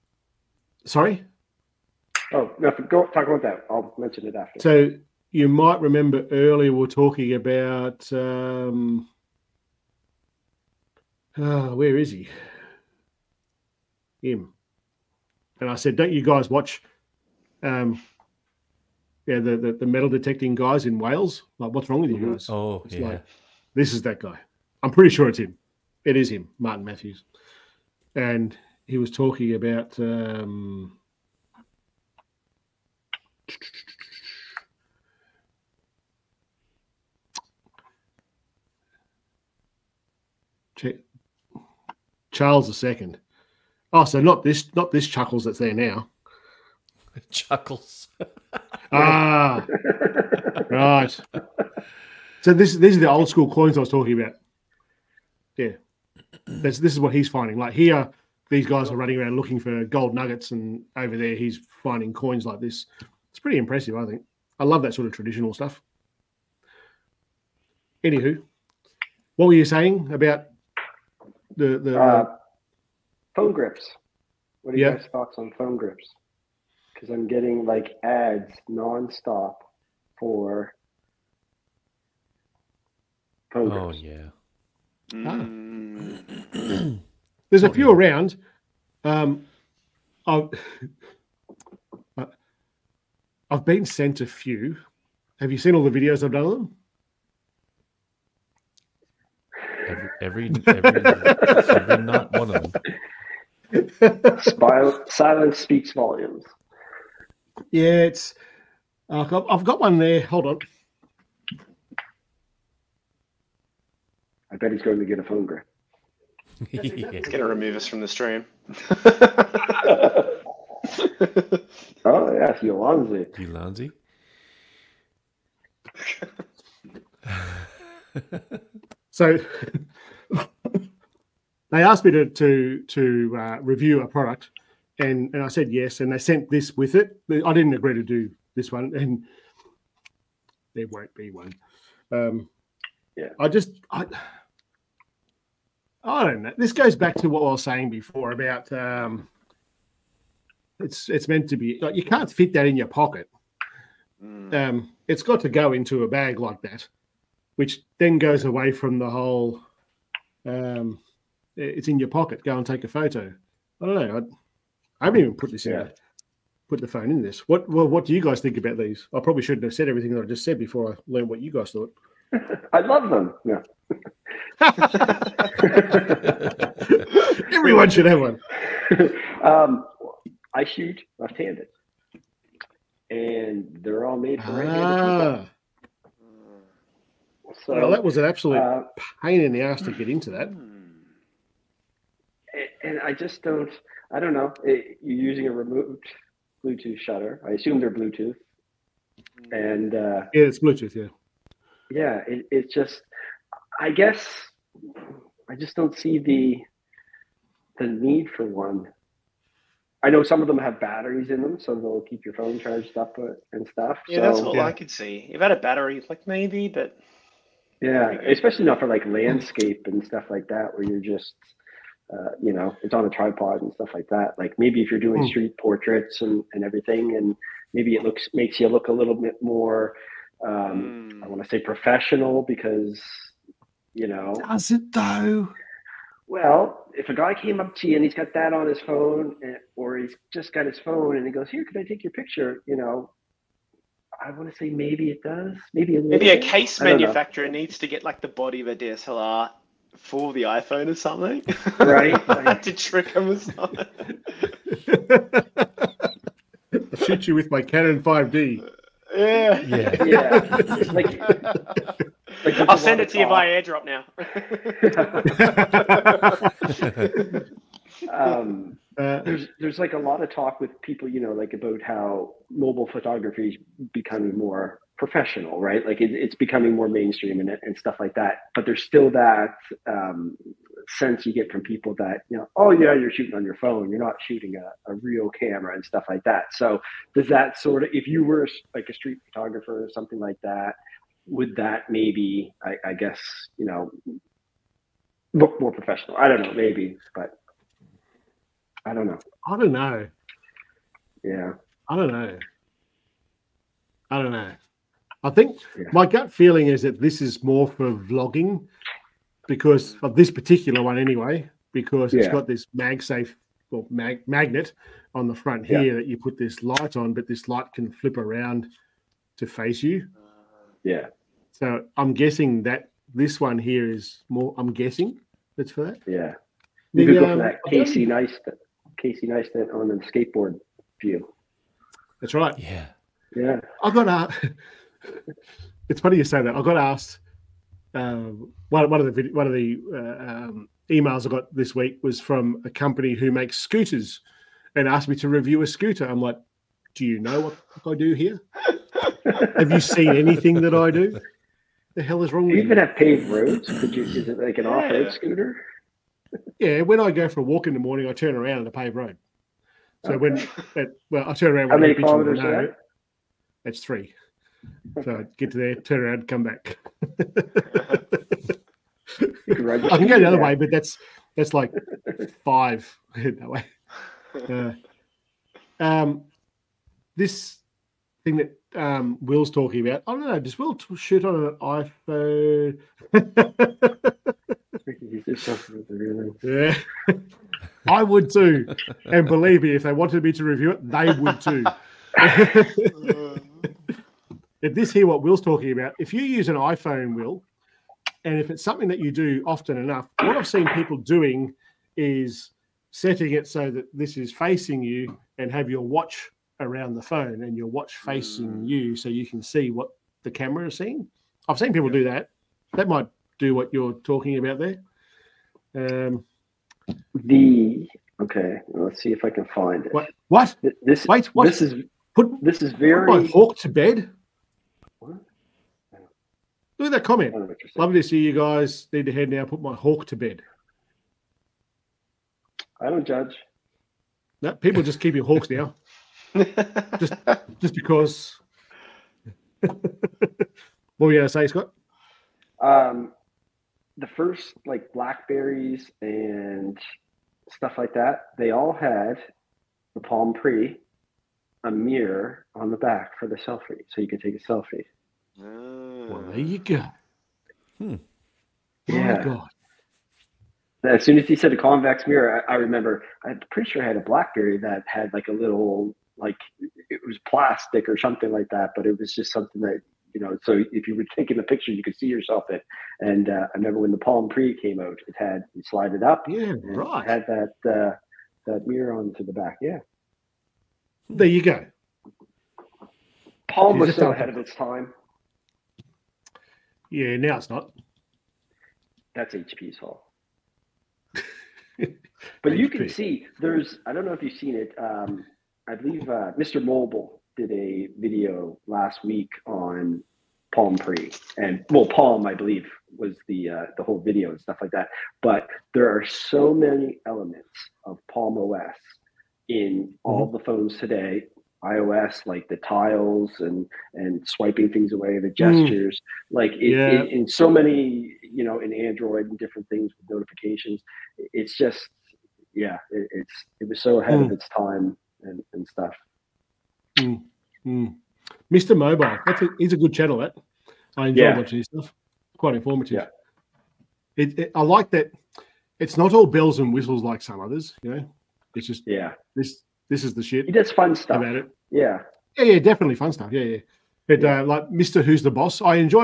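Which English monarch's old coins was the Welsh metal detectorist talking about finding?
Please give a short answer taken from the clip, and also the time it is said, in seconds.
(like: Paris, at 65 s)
Charles II, at 42 s.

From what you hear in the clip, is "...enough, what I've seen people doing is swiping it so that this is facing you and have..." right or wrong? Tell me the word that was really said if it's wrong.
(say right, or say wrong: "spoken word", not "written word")
wrong: "setting", not "swiping".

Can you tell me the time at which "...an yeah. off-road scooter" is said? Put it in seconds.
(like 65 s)
354 s.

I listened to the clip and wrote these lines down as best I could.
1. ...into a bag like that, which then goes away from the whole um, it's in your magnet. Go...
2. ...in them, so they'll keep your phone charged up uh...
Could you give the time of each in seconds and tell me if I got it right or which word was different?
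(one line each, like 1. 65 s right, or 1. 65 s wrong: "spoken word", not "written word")
1. 155 s wrong: "pocket", not "magnet"
2. 211 s right.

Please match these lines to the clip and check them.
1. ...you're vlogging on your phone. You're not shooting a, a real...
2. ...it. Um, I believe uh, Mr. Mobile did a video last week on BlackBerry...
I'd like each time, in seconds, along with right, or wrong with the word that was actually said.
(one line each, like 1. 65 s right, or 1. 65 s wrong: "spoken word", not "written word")
1. 282 s wrong: "shooting", not "vlogging"
2. 494 s wrong: "Palm", not "BlackBerry".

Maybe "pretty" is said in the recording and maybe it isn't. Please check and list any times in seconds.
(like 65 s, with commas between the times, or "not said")
24 s, 63 s, 463 s.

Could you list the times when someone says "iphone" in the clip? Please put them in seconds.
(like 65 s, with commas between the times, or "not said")
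250 s, 382 s, 396 s.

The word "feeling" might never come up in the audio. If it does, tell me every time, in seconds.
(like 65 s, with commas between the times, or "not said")
306 s.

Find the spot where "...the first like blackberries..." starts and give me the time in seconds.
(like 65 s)
444 s.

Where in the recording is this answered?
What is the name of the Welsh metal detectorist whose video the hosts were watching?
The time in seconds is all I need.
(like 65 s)
26 s.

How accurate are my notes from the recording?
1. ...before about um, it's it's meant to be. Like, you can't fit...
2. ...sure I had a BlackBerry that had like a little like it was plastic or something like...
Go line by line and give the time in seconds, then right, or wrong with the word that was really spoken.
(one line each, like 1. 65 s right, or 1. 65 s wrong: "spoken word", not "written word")
1. 147 s right
2. 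463 s right.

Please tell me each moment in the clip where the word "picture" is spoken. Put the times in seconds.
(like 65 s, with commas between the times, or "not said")
242 s, 471 s.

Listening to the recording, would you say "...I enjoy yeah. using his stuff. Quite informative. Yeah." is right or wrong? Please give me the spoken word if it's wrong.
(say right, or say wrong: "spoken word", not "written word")
wrong: "watching", not "using".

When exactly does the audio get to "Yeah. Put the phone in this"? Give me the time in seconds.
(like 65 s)
165 s.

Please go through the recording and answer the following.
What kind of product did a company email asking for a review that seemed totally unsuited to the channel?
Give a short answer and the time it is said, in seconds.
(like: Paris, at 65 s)
A scooter, at 343 s.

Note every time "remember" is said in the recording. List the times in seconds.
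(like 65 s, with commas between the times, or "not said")
5 s, 462 s, 473 s.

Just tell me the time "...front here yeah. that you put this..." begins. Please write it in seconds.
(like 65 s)
315 s.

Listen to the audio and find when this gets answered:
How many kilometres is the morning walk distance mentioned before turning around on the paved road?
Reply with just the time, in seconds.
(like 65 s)
363 s.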